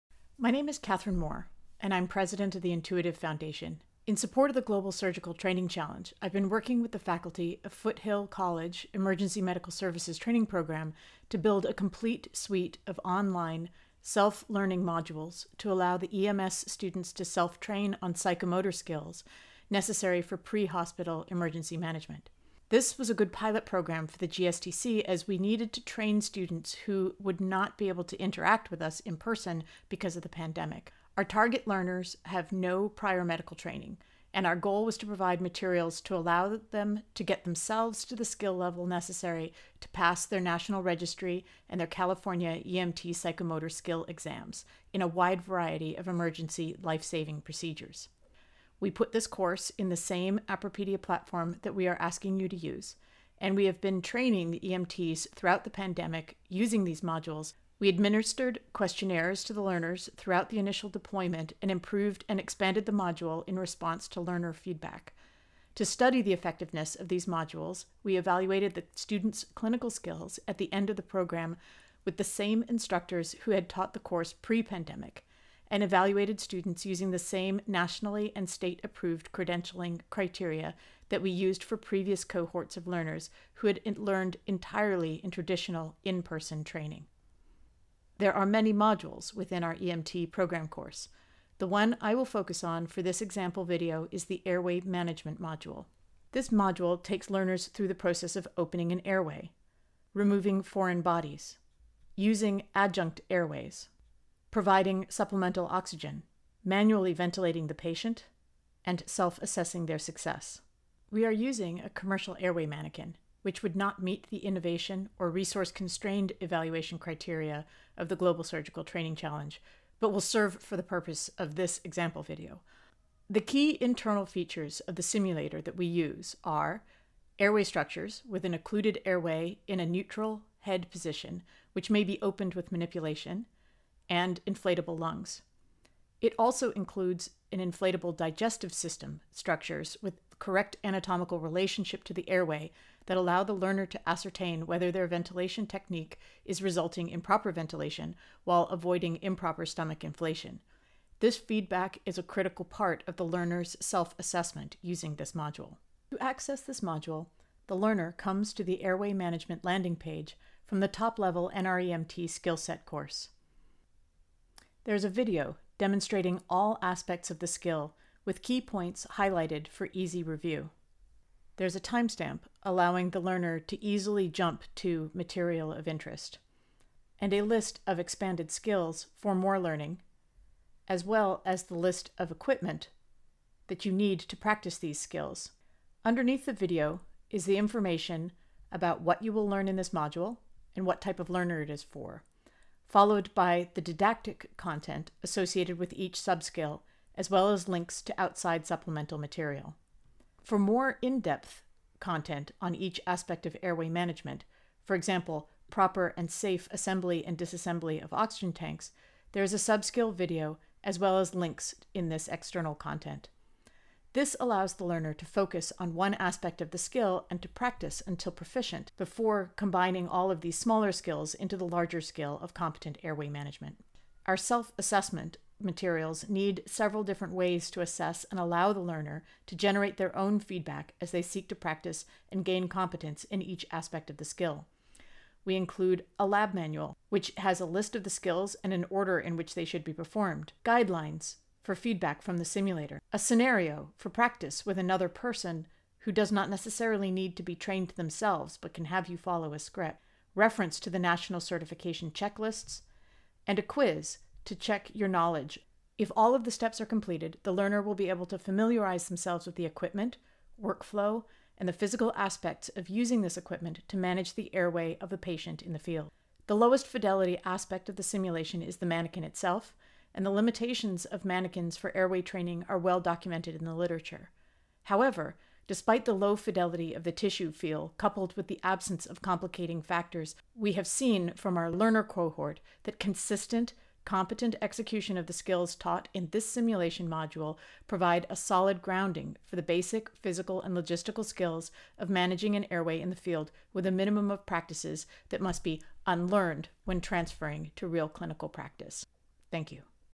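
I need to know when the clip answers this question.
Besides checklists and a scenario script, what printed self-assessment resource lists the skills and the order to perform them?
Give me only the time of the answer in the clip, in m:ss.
3:56.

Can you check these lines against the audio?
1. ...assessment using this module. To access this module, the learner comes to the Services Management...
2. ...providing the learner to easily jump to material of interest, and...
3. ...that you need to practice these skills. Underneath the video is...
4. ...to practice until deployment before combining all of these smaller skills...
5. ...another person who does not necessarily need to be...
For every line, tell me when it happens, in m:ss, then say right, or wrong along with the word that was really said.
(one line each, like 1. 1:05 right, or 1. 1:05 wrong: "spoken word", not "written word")
1. 2:34 wrong: "Airway", not "Services"
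2. 2:52 wrong: "allowing", not "providing"
3. 3:03 right
4. 3:37 wrong: "proficient", not "deployment"
5. 4:04 right.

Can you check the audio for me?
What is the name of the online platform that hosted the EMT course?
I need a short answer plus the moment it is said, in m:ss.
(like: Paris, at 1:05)
Appropedia, at 0:50.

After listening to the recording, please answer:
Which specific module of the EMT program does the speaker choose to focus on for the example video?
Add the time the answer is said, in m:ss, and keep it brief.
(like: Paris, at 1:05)
airway management module, at 1:34.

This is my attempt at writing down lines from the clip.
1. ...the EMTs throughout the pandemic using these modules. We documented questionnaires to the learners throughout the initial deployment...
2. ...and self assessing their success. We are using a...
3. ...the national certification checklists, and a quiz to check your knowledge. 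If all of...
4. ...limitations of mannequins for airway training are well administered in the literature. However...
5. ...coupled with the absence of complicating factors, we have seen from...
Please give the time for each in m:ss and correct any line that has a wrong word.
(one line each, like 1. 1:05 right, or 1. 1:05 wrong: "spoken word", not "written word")
1. 0:54 wrong: "administered", not "documented"
2. 1:48 right
3. 4:10 right
4. 4:30 wrong: "documented", not "administered"
5. 4:37 right.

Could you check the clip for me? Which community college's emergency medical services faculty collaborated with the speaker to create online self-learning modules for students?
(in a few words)
Foothill College.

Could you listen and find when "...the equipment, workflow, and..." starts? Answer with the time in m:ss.
4:19.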